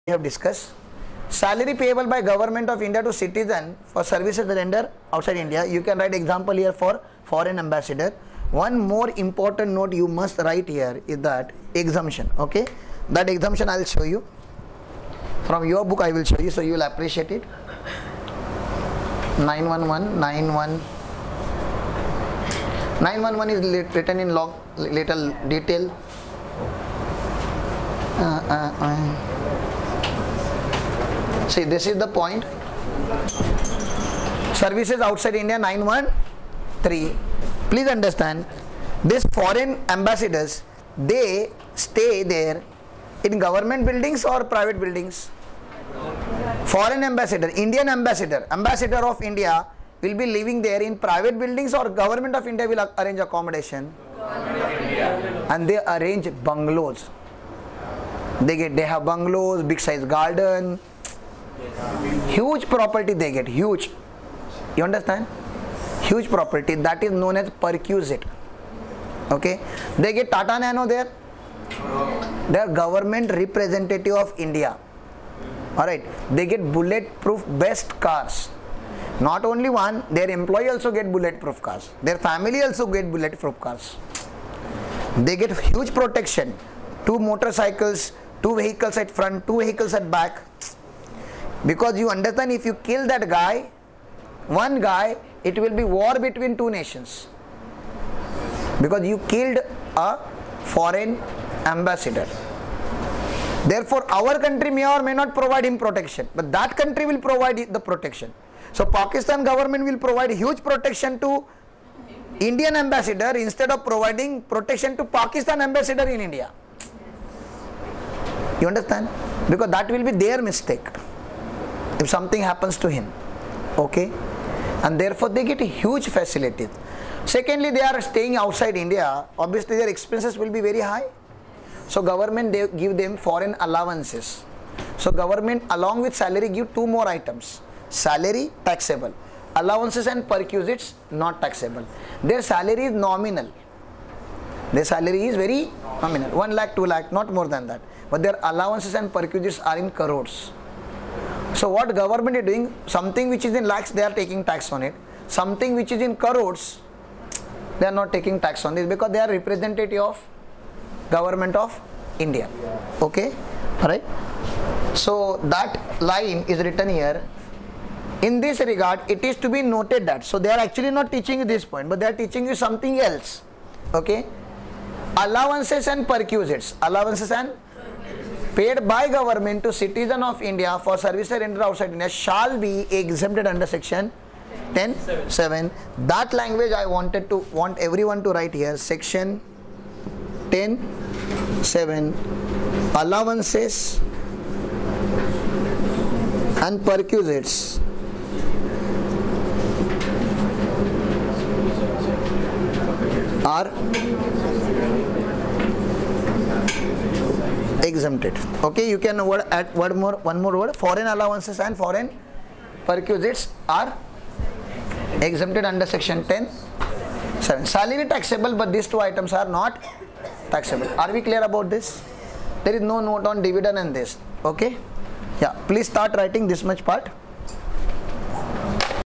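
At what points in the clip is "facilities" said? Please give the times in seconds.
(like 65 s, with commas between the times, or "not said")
126 s.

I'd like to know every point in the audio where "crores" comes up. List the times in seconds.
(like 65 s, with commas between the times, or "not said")
150 s, 156 s.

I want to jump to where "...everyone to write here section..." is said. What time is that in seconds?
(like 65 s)
187 s.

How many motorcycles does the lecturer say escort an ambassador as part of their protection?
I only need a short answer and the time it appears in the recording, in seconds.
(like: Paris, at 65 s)
2, at 87 s.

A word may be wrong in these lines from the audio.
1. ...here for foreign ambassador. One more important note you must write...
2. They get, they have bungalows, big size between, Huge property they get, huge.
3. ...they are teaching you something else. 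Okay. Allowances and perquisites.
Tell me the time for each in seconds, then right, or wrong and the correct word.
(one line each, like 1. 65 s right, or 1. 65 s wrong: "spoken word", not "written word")
1. 6 s right
2. 58 s wrong: "garden", not "between"
3. 171 s right.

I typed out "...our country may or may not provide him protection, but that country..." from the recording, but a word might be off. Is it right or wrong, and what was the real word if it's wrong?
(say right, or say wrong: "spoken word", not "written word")
right.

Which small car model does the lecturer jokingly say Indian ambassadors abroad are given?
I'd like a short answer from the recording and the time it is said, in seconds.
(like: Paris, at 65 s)
Tata Nano, at 70 s.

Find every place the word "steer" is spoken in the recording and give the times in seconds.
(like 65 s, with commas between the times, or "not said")
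not said.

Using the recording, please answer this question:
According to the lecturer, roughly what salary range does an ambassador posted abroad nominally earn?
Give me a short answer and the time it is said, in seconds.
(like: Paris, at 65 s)
1 lakh 2 lakh, at 146 s.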